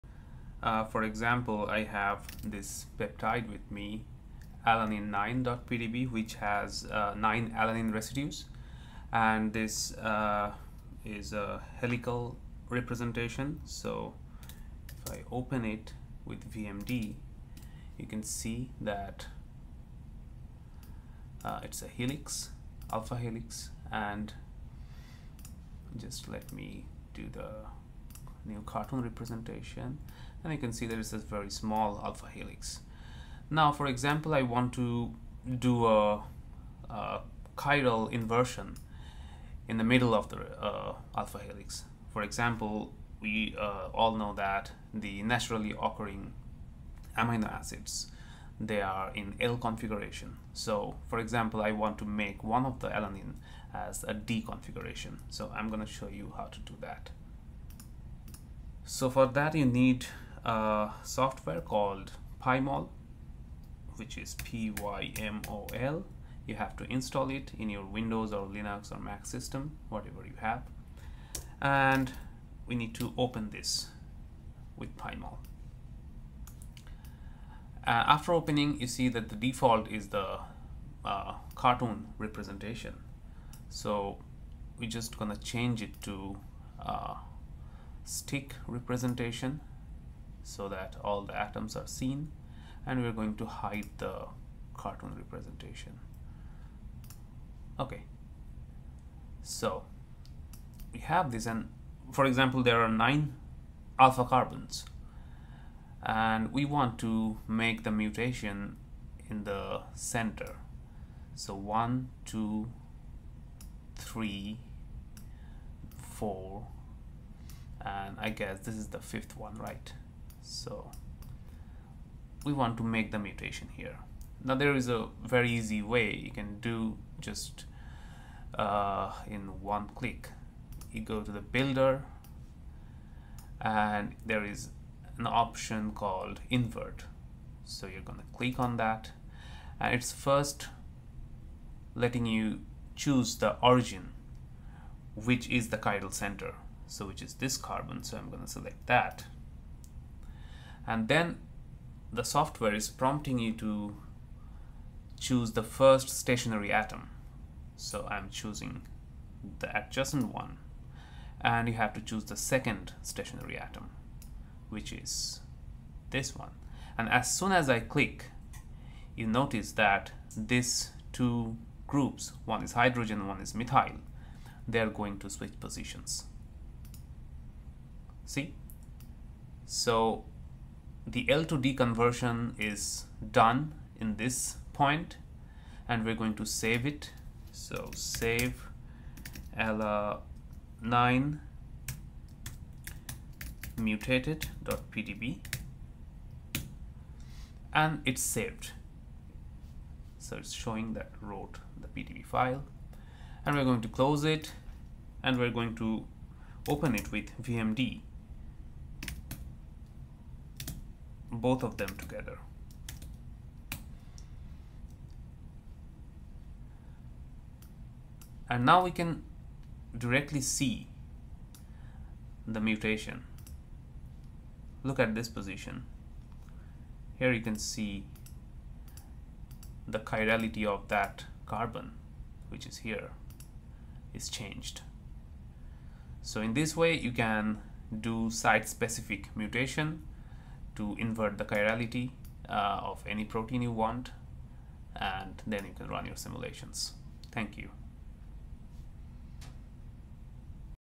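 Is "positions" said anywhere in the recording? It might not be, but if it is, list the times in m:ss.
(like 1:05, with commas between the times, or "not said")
2:55, 3:45.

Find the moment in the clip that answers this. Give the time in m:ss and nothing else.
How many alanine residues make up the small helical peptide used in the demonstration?
0:07.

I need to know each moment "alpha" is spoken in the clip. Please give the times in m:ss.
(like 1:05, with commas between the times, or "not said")
0:22, 0:32, 0:41, 1:43.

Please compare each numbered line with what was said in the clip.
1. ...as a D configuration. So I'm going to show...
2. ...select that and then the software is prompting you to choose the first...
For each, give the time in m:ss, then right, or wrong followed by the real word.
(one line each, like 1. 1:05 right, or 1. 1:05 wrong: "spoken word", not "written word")
1. 0:53 right
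2. 2:28 right.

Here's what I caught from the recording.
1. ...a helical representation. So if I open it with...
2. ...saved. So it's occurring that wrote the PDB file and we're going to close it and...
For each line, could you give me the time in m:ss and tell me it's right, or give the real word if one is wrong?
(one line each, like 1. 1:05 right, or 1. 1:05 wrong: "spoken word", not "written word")
1. 0:11 right
2. 3:18 wrong: "showing", not "occurring".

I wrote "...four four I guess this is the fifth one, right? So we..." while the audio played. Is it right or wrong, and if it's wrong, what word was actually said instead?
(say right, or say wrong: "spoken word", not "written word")
wrong: "three", not "four".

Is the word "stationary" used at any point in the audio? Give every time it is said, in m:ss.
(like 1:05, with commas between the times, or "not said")
2:36, 2:43.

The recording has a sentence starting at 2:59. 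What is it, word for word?
So the L to D conversion is done in this point and we're going to save it.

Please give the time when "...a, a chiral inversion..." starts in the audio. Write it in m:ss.
0:35.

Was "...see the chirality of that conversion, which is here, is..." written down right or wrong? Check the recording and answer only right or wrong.
wrong.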